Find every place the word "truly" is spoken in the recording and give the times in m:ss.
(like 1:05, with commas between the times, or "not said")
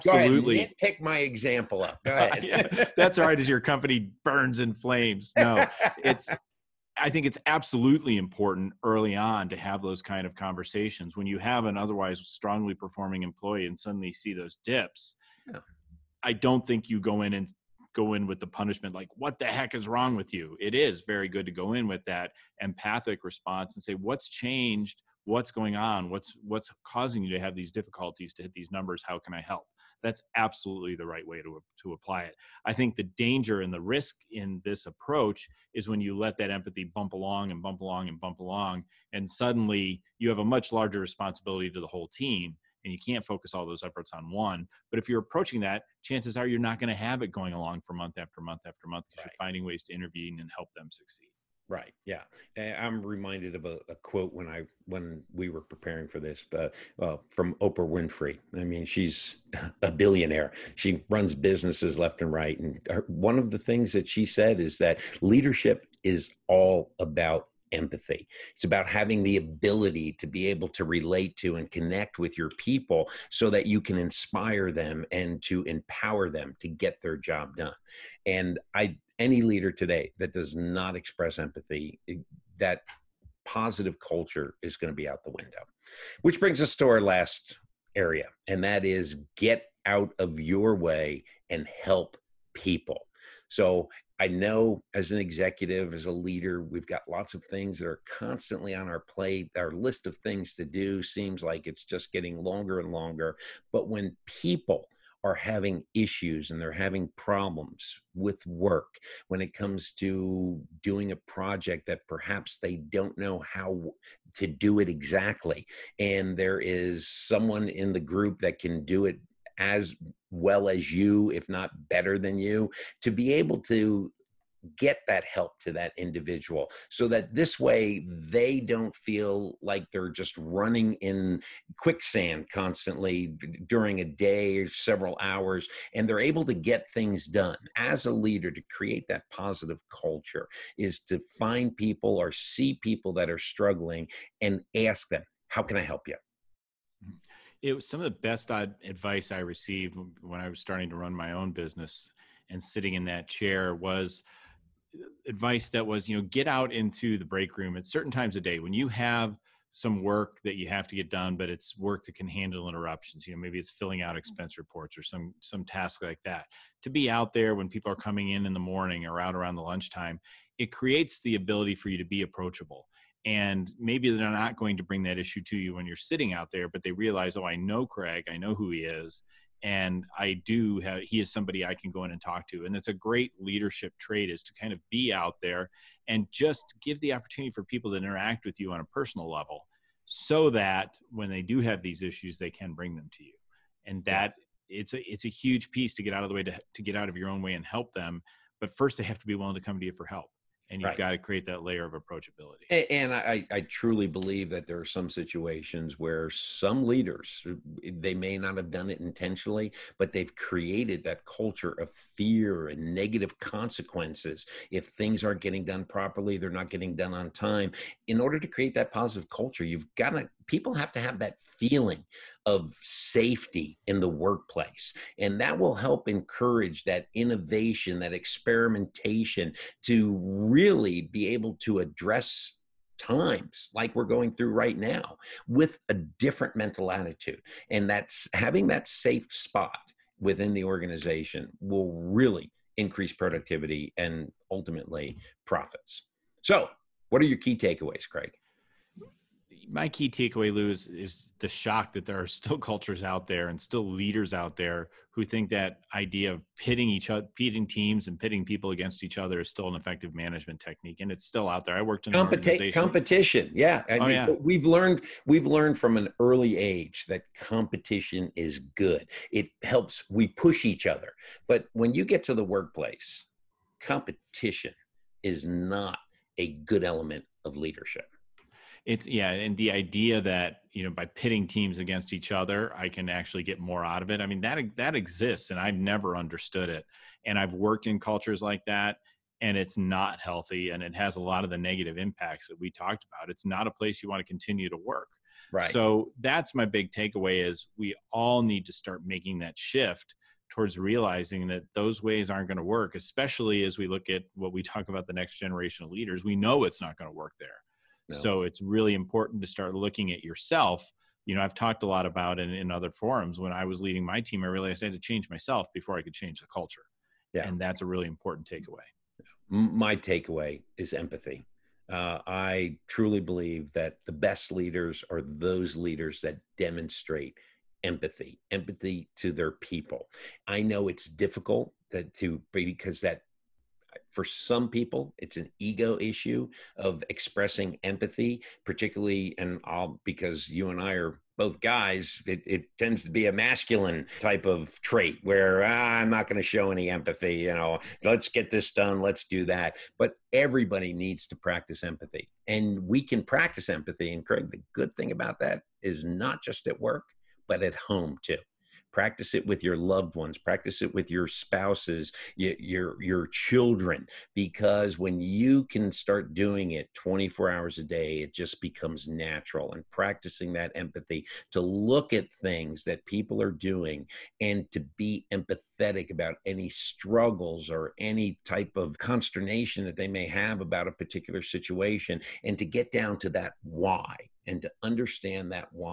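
3:23, 5:22.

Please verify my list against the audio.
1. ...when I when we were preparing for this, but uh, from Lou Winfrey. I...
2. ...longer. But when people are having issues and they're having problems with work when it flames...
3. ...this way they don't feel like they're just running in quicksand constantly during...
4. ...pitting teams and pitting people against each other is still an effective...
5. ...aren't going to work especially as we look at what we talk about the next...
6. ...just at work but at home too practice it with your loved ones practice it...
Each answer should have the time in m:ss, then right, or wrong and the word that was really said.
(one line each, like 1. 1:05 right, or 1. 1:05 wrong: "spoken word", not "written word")
1. 0:54 wrong: "Oprah", not "Lou"
2. 1:42 wrong: "comes", not "flames"
3. 2:07 right
4. 4:17 right
5. 5:02 right
6. 5:56 right.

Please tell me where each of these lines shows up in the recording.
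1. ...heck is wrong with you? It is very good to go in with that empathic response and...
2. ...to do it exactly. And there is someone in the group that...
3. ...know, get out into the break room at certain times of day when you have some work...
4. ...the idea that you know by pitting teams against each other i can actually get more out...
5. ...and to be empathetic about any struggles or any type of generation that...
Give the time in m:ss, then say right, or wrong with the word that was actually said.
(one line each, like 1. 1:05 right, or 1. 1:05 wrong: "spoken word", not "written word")
1. 0:19 right
2. 1:54 right
3. 2:36 right
4. 4:39 right
5. 6:14 wrong: "consternation", not "generation".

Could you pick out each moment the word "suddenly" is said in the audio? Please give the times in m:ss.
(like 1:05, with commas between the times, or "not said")
0:13, 0:39.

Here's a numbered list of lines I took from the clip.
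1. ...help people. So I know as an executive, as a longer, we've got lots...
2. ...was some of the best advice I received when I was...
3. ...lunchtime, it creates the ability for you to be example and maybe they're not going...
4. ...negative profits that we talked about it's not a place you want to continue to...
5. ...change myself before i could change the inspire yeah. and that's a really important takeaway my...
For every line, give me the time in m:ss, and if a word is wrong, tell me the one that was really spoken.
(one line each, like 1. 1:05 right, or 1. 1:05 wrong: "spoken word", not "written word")
1. 1:31 wrong: "leader", not "longer"
2. 2:27 right
3. 2:49 wrong: "approachable", not "example"
4. 4:51 wrong: "impacts", not "profits"
5. 5:14 wrong: "culture", not "inspire".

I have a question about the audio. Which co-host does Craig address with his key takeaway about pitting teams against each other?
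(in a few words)
Lou.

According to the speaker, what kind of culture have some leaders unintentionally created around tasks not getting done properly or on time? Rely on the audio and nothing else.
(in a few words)
culture of fear.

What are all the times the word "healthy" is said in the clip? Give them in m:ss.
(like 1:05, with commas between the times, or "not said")
4:50.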